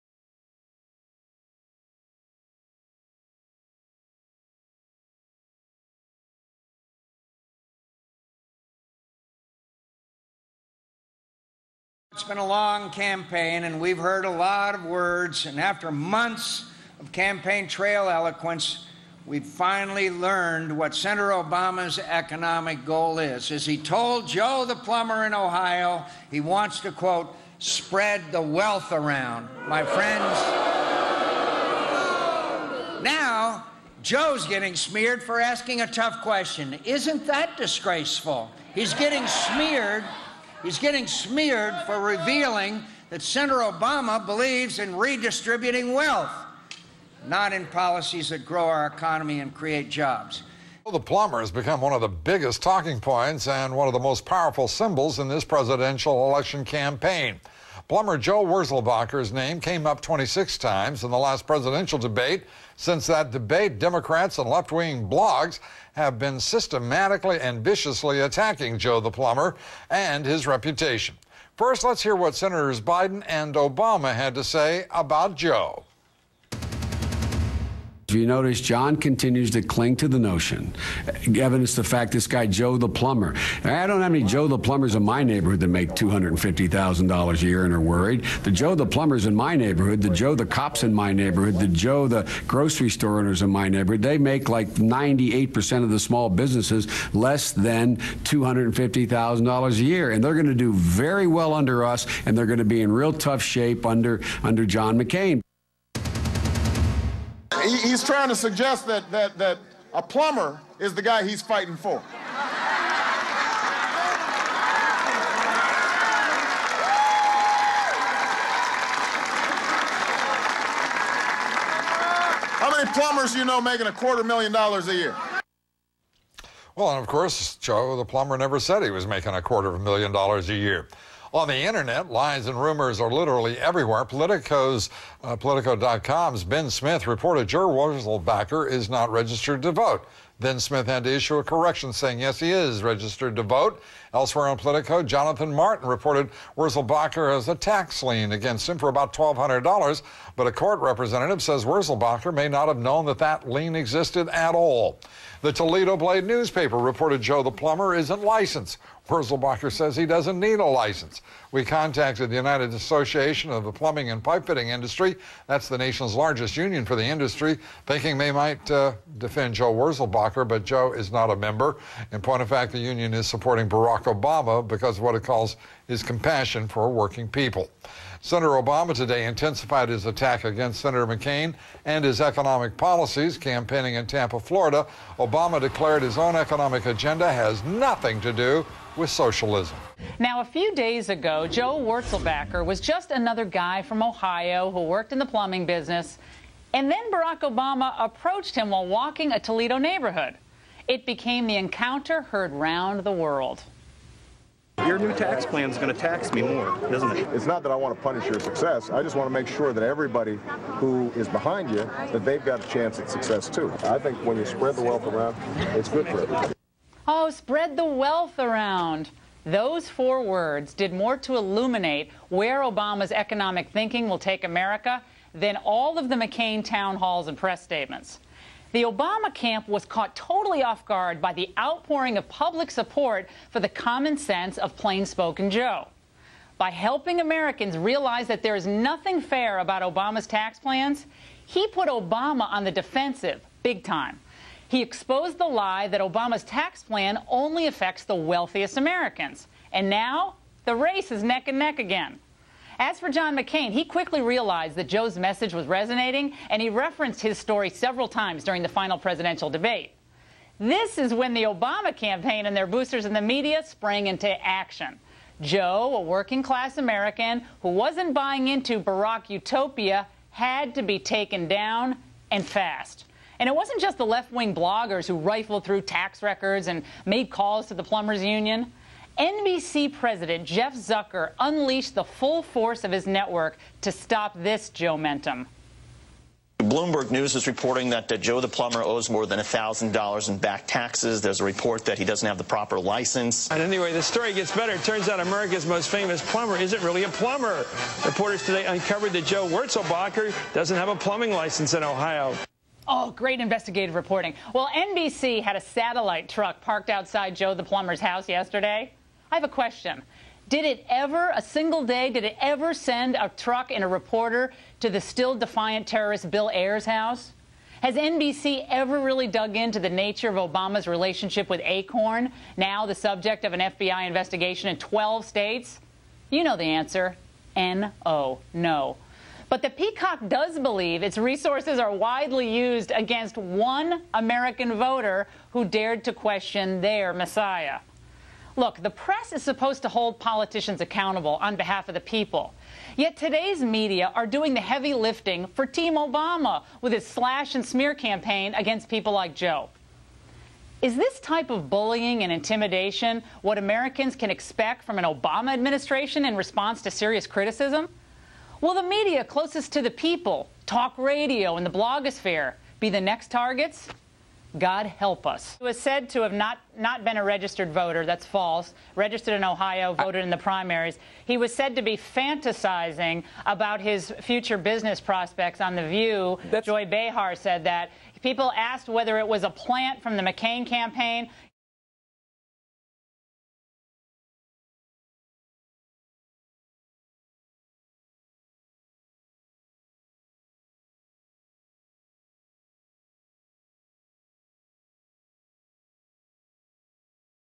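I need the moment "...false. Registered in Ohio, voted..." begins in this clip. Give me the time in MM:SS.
06:08.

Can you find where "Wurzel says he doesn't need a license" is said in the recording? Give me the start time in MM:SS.
02:39.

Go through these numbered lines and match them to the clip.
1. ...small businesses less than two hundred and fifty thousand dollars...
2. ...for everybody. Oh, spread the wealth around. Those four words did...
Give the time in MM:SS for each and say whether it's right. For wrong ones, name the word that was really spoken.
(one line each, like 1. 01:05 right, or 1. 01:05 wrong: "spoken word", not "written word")
1. 01:35 right
2. 03:36 right.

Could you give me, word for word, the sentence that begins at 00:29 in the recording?
My friends, now Joe's getting smeared for asking a tough question.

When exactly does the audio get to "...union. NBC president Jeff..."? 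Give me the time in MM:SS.
04:38.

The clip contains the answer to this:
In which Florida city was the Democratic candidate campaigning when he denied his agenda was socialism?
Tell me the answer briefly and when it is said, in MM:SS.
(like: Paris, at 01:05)
Tampa, at 03:04.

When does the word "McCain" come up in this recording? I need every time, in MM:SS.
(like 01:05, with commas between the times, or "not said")
01:44, 03:01, 03:46, 04:13, 06:20.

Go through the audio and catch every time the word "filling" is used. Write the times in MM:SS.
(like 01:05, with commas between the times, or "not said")
not said.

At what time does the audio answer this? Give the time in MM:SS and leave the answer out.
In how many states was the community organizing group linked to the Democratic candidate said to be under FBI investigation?
05:24.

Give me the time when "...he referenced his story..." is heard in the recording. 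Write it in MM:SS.
04:16.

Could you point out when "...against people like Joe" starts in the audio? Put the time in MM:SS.
05:48.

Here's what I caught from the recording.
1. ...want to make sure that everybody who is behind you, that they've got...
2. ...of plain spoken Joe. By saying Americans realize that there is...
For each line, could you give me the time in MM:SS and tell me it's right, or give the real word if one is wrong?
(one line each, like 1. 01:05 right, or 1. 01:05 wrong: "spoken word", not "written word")
1. 03:29 right
2. 03:54 wrong: "helping", not "saying".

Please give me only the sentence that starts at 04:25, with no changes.
Joe, a working class American who wasn't buying into Barack utopia, had to be taken down and fast.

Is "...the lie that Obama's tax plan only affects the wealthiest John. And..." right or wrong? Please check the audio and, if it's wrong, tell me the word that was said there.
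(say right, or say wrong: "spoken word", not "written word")
wrong: "Americans", not "John".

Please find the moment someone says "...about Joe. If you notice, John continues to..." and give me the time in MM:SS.
01:14.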